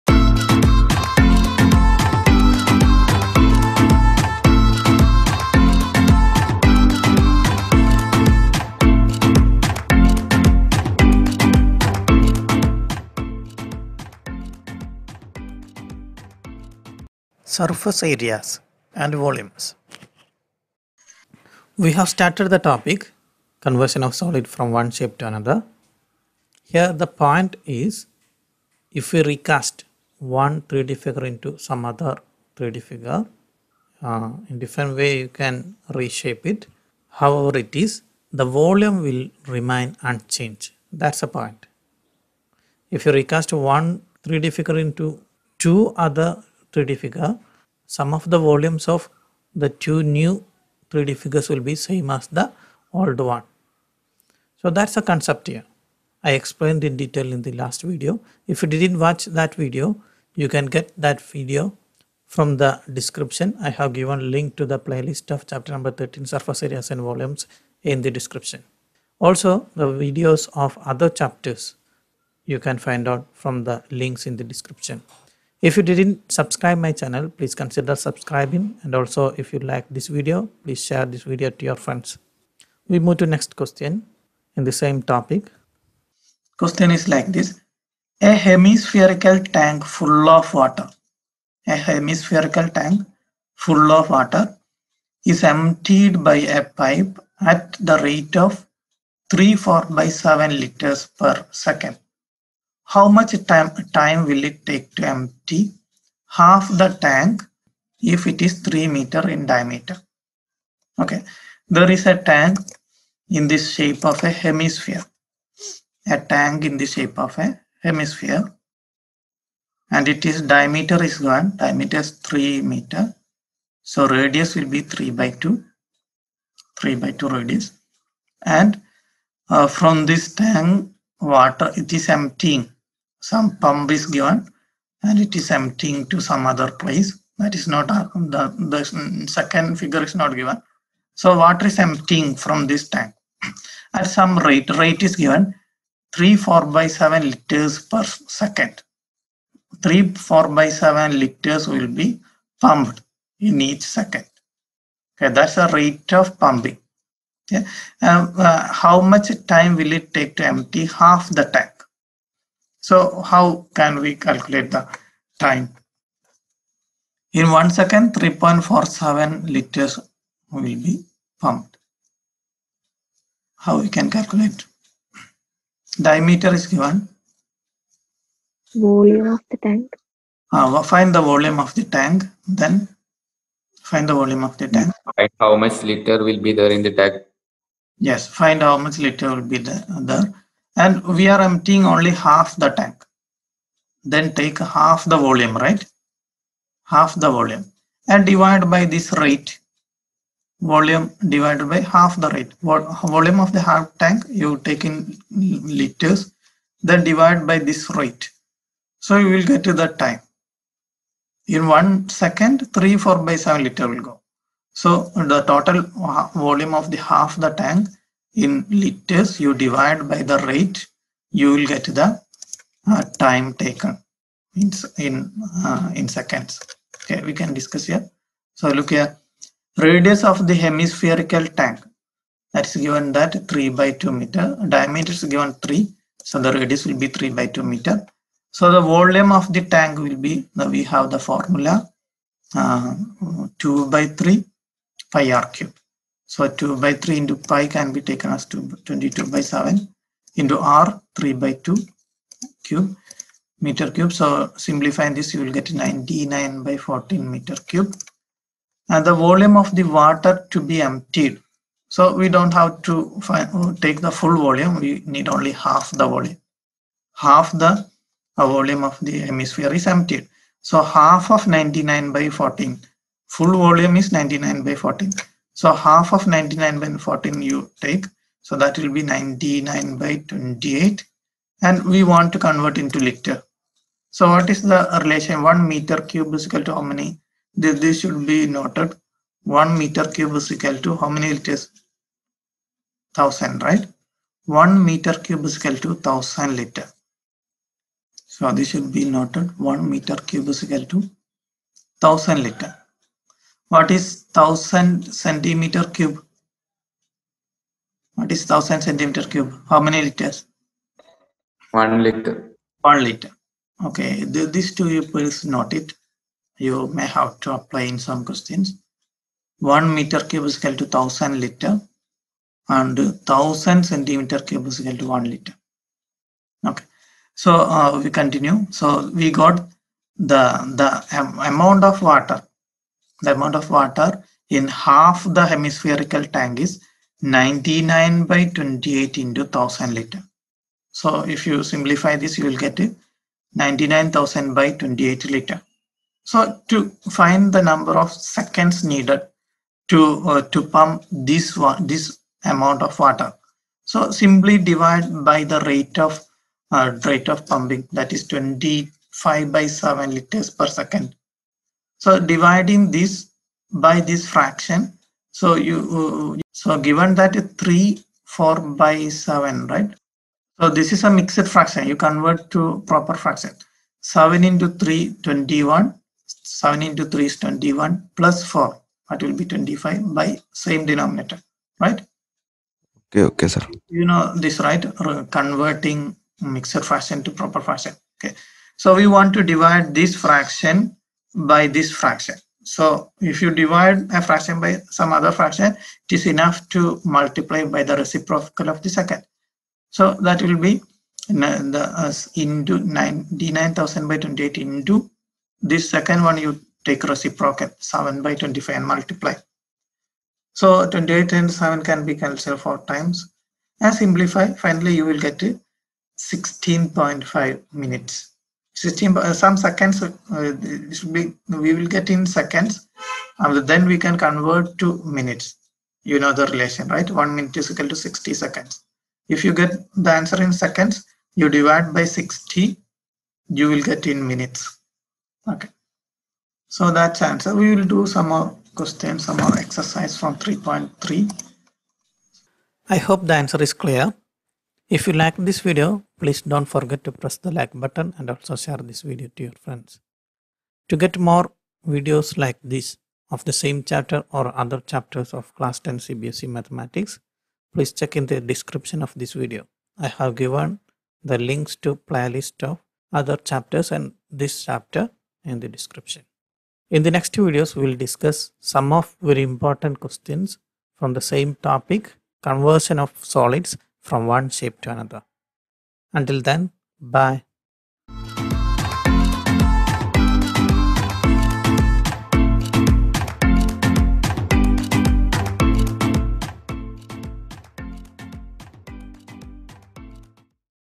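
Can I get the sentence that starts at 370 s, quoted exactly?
So this is a mixed fraction.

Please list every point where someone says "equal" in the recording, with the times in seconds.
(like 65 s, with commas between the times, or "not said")
286 s, 290 s, 295 s, 300 s, 320 s, 324 s, 427 s.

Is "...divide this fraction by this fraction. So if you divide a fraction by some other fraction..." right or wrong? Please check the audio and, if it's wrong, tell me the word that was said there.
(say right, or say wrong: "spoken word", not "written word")
right.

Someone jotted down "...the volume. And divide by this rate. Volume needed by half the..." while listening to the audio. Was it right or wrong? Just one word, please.
wrong.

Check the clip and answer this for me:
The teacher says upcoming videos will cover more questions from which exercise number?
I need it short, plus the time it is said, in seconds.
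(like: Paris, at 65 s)
3.3, at 440 s.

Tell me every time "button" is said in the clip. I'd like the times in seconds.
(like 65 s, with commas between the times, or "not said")
447 s.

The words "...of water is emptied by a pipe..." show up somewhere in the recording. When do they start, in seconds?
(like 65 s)
93 s.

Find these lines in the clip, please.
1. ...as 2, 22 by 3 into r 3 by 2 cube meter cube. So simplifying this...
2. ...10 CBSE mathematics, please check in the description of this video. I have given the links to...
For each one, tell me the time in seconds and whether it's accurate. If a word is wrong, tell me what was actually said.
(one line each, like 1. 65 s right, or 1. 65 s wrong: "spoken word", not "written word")
1. 248 s wrong: "7", not "3"
2. 455 s right.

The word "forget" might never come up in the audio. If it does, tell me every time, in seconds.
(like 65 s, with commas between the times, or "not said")
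446 s.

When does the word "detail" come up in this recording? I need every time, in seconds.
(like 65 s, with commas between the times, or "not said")
56 s.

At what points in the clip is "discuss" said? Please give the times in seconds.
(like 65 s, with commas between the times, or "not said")
227 s, 467 s.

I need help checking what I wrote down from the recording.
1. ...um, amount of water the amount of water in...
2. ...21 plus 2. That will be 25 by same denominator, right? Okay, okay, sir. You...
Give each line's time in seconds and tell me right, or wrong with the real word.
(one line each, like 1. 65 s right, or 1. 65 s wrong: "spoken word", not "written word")
1. 331 s right
2. 377 s wrong: "4", not "2".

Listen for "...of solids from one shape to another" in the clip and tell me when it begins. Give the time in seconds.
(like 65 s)
472 s.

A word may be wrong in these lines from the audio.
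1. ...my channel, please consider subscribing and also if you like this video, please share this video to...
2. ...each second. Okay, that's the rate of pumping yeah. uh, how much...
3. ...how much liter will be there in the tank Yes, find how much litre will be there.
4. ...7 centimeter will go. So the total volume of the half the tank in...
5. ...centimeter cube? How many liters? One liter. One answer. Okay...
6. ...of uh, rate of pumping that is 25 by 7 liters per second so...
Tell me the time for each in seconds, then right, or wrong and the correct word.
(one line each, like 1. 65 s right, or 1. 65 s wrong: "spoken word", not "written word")
1. 76 s right
2. 153 s right
3. 185 s right
4. 213 s wrong: "liter", not "centimeter"
5. 308 s wrong: "liter", not "answer"
6. 355 s right.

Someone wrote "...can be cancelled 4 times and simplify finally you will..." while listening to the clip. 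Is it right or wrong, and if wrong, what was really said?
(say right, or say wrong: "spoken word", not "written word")
right.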